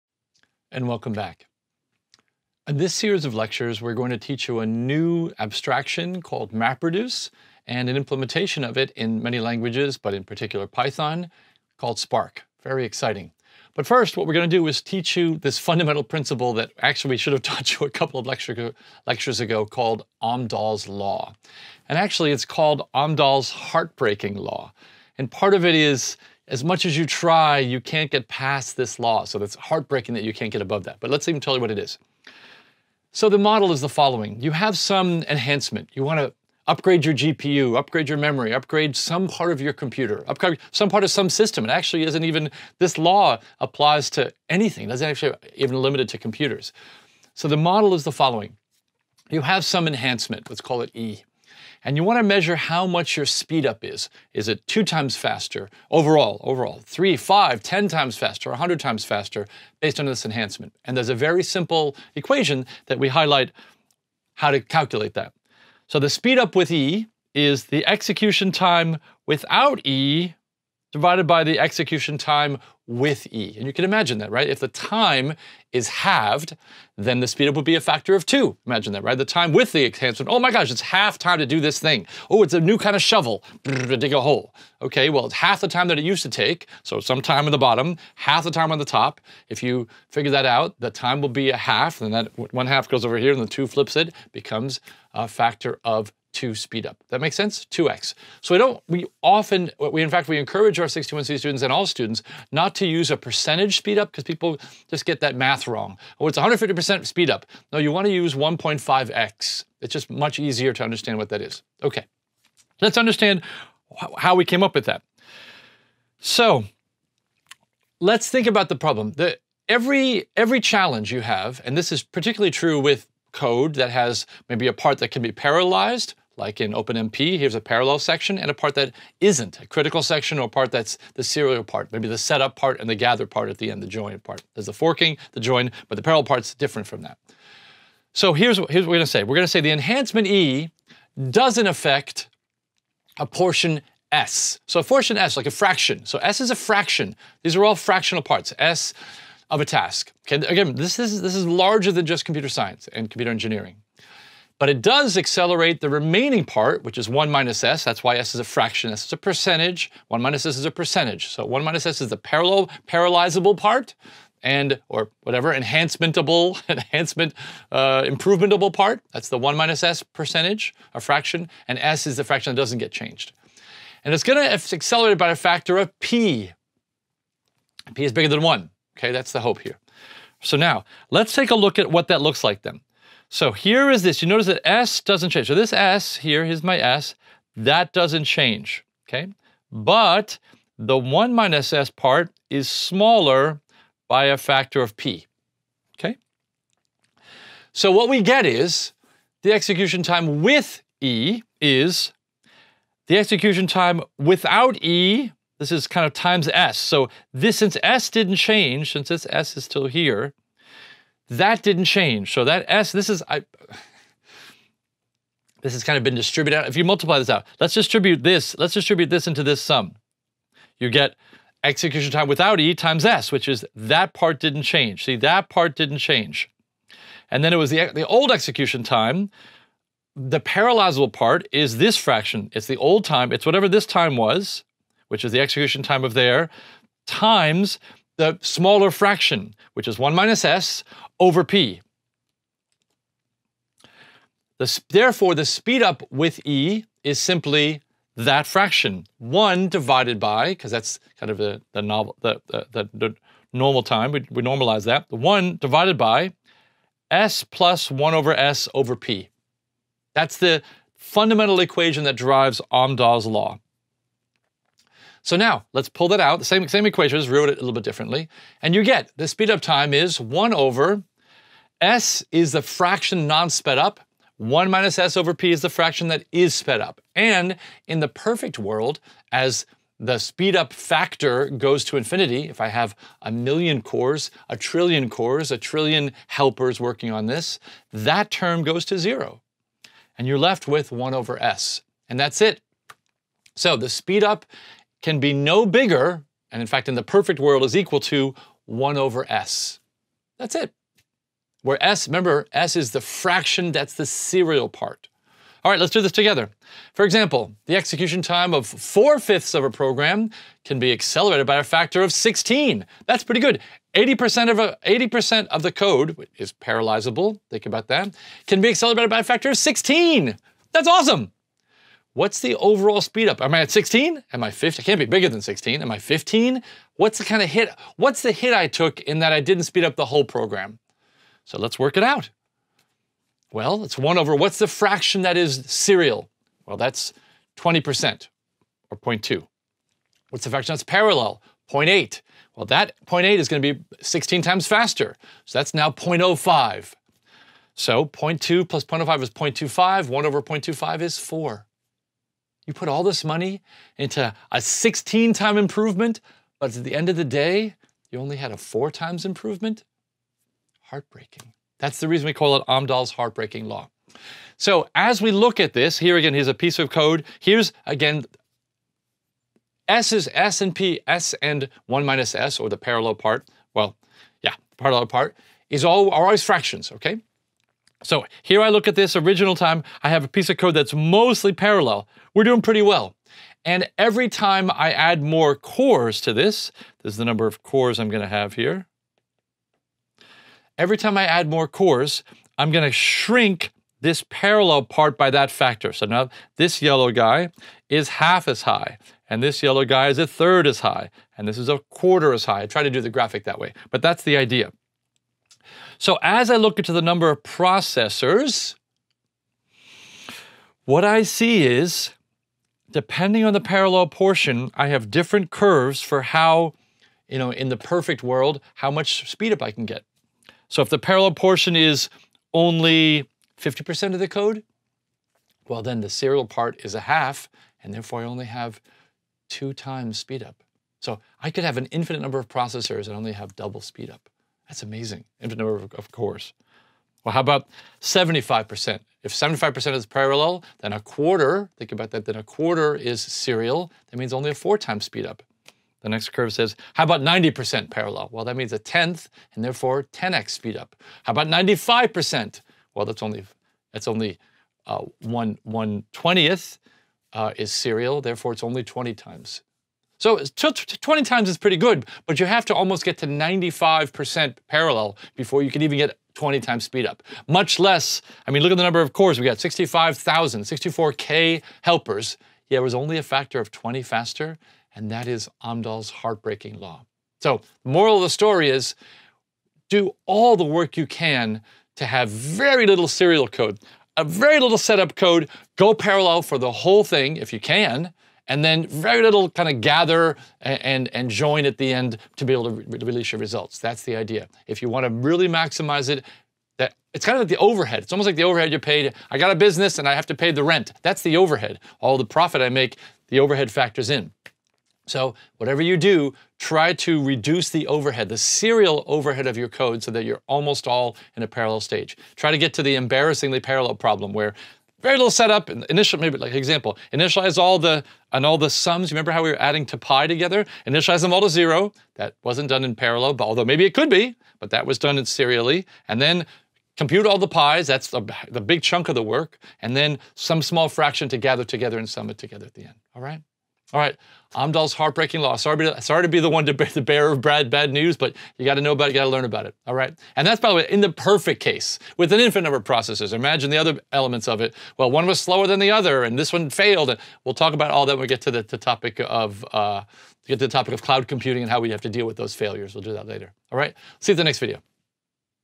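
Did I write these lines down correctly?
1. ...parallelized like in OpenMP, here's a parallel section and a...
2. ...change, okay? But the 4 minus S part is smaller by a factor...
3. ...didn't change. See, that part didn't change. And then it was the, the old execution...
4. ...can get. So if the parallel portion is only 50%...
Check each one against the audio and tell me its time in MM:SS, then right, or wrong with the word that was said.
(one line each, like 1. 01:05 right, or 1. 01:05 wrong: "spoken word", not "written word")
1. 02:05 right
2. 03:08 wrong: "1", not "4"
3. 03:44 right
4. 06:59 right.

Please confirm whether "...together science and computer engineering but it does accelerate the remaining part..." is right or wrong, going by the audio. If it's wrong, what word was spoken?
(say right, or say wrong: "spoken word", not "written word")
wrong: "computer", not "together".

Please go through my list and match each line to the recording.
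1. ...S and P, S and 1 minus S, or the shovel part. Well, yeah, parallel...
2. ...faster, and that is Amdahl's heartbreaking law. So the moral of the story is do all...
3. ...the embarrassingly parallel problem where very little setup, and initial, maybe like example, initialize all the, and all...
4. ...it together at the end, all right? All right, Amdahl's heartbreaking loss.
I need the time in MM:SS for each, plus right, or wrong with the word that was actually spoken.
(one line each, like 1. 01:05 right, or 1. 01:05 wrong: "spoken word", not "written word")
1. 06:10 wrong: "parallel", not "shovel"
2. 07:54 right
3. 08:32 right
4. 08:52 right.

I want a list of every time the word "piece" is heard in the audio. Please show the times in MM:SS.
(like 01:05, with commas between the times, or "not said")
06:06, 06:20.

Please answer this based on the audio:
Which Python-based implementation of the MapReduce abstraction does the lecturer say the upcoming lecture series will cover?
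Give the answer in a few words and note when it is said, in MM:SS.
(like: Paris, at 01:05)
Spark, at 00:11.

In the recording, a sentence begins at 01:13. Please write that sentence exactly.
And you can imagine that, right?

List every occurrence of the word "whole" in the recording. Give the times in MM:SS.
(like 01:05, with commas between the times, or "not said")
05:30, 08:06.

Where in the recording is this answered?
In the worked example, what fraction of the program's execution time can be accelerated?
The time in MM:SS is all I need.
05:08.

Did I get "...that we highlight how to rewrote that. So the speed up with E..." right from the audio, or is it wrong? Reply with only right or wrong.
wrong.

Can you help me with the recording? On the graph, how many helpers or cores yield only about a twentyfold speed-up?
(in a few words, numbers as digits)
64K.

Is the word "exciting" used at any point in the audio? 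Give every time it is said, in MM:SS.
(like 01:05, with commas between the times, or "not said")
00:12.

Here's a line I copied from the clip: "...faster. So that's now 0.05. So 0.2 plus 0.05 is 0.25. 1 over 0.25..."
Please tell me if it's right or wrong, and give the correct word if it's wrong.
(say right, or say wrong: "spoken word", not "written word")
right.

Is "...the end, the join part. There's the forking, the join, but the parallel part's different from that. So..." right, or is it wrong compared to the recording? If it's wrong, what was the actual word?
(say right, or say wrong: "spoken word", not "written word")
right.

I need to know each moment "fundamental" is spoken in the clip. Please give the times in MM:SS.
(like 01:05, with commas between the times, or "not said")
00:15, 04:20.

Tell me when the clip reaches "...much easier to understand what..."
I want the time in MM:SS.
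01:50.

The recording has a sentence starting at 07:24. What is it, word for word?
That means only a four times speed up.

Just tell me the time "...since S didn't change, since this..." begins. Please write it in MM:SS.
03:27.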